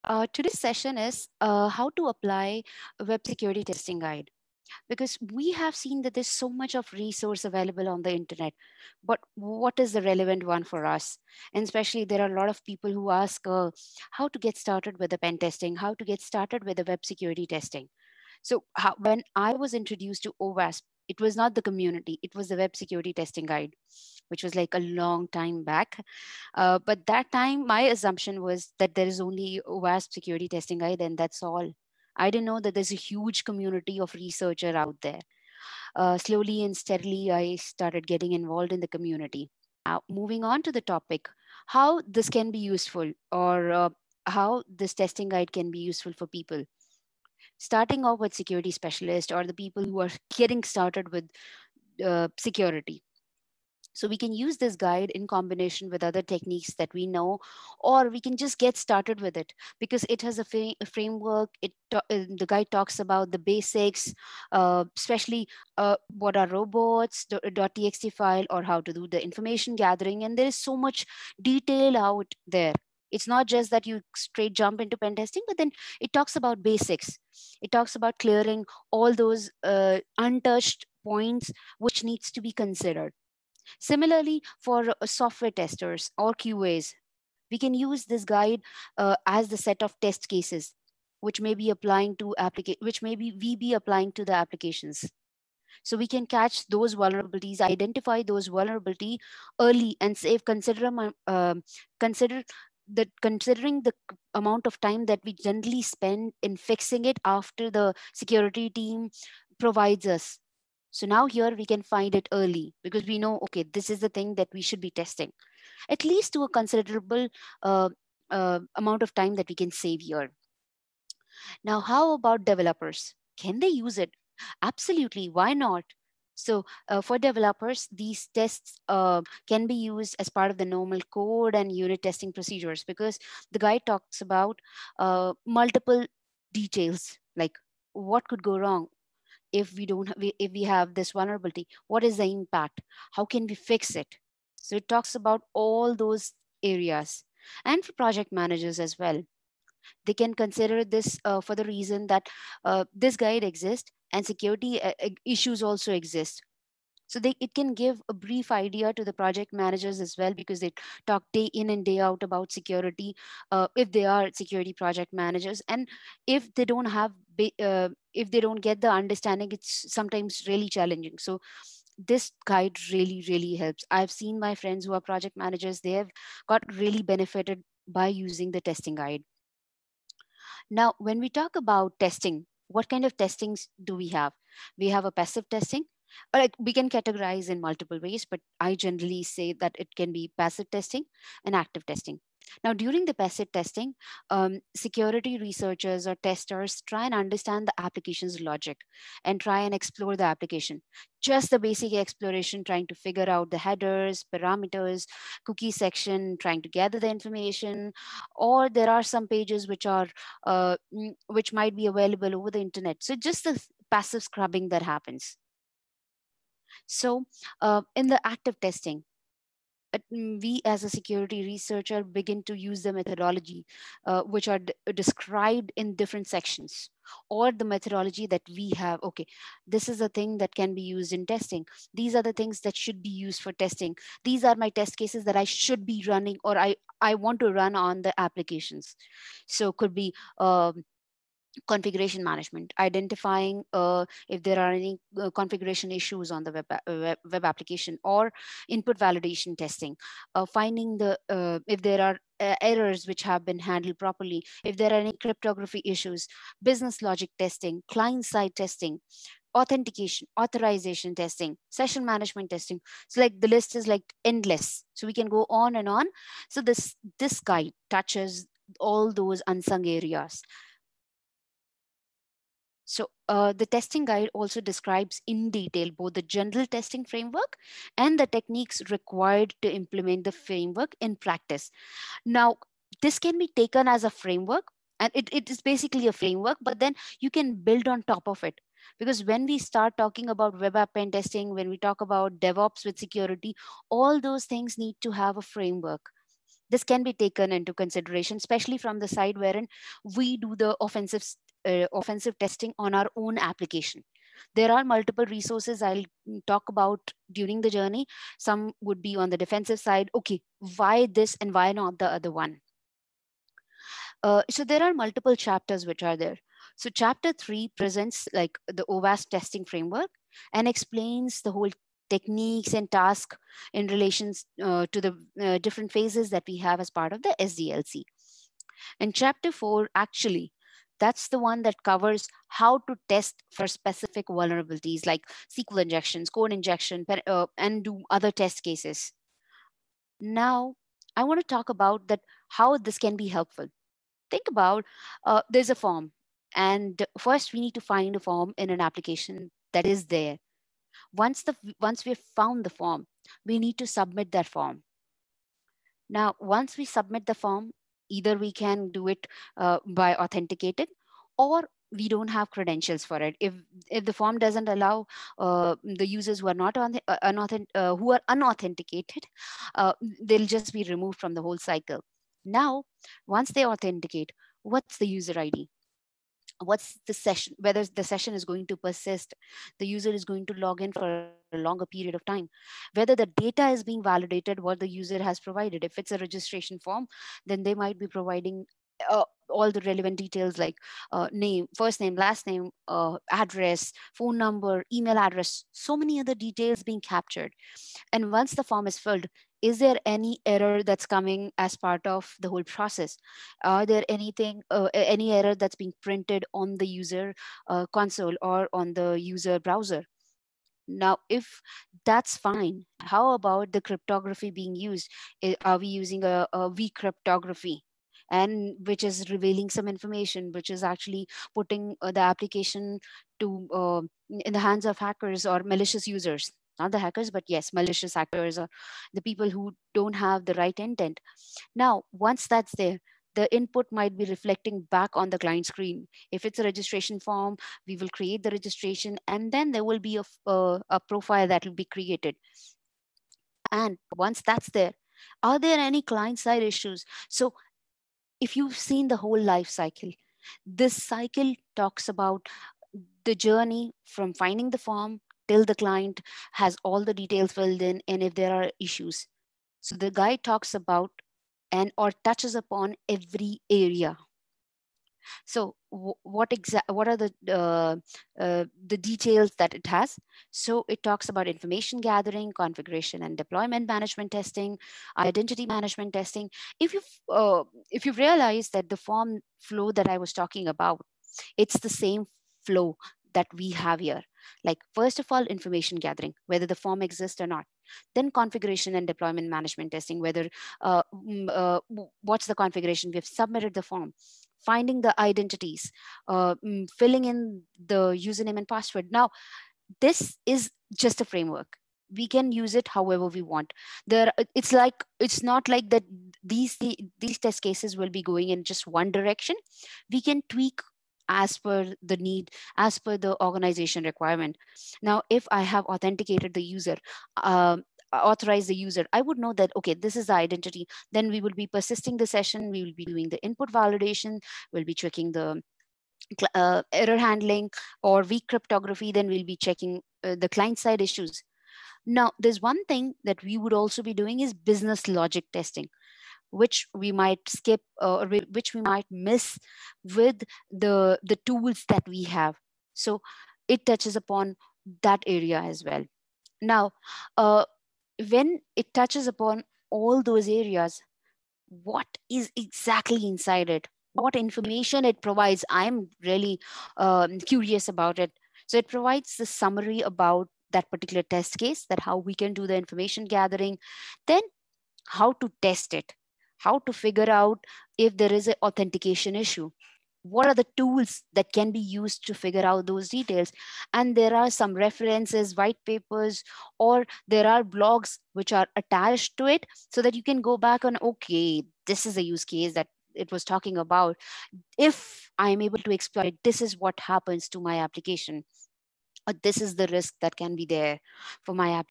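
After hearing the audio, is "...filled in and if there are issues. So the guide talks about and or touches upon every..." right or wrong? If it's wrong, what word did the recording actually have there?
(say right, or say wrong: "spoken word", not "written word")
right.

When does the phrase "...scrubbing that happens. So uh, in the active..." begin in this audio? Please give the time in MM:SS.
03:34.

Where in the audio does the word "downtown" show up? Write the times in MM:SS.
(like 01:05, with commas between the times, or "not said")
not said.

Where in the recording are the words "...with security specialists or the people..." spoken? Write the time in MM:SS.
00:48.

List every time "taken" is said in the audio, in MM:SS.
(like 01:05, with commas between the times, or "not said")
04:43, 04:57.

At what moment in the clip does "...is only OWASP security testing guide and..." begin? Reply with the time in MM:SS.
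00:29.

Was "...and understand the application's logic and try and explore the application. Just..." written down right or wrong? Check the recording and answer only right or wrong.
right.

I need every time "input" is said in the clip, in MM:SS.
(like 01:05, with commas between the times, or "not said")
04:08, 07:13, 08:43.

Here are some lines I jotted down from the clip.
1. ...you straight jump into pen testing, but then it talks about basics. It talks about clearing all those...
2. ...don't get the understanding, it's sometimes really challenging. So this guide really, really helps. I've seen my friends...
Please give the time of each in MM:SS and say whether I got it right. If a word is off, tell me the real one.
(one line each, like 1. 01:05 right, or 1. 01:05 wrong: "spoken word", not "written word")
1. 01:13 right
2. 02:48 right.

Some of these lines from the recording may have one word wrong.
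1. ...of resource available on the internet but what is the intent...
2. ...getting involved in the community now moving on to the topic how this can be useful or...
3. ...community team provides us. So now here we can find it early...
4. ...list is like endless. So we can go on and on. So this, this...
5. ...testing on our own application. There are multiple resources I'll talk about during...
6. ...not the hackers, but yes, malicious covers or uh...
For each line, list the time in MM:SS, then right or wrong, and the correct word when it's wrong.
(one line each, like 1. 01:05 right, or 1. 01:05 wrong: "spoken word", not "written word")
1. 00:06 wrong: "relevant", not "intent"
2. 00:38 right
3. 01:48 wrong: "security", not "community"
4. 04:23 right
5. 05:02 right
6. 07:06 wrong: "actors", not "covers".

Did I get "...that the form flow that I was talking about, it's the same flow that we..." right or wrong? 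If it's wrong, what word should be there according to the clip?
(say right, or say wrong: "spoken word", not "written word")
right.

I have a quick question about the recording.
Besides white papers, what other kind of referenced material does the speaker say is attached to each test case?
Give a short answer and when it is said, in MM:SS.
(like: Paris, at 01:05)
Blogs, at 09:37.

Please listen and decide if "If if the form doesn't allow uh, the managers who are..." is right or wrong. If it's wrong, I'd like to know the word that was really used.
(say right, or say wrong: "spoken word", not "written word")
wrong: "users", not "managers".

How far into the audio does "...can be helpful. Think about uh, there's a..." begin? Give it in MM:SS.
05:42.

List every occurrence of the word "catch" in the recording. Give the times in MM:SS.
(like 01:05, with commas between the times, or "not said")
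01:36.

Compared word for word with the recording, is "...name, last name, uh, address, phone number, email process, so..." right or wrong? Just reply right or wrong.
wrong.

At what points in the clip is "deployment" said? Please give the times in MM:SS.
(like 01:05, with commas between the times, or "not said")
07:53, 08:09.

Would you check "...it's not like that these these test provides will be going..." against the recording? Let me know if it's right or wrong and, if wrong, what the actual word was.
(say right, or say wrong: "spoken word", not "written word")
wrong: "cases", not "provides".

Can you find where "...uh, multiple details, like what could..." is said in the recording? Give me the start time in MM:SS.
02:14.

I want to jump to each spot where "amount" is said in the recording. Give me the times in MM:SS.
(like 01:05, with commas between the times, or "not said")
01:44, 01:58.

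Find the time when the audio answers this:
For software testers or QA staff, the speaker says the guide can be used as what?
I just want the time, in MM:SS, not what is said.
01:29.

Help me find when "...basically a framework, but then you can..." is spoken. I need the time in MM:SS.
04:45.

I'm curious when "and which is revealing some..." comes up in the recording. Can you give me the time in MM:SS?
06:58.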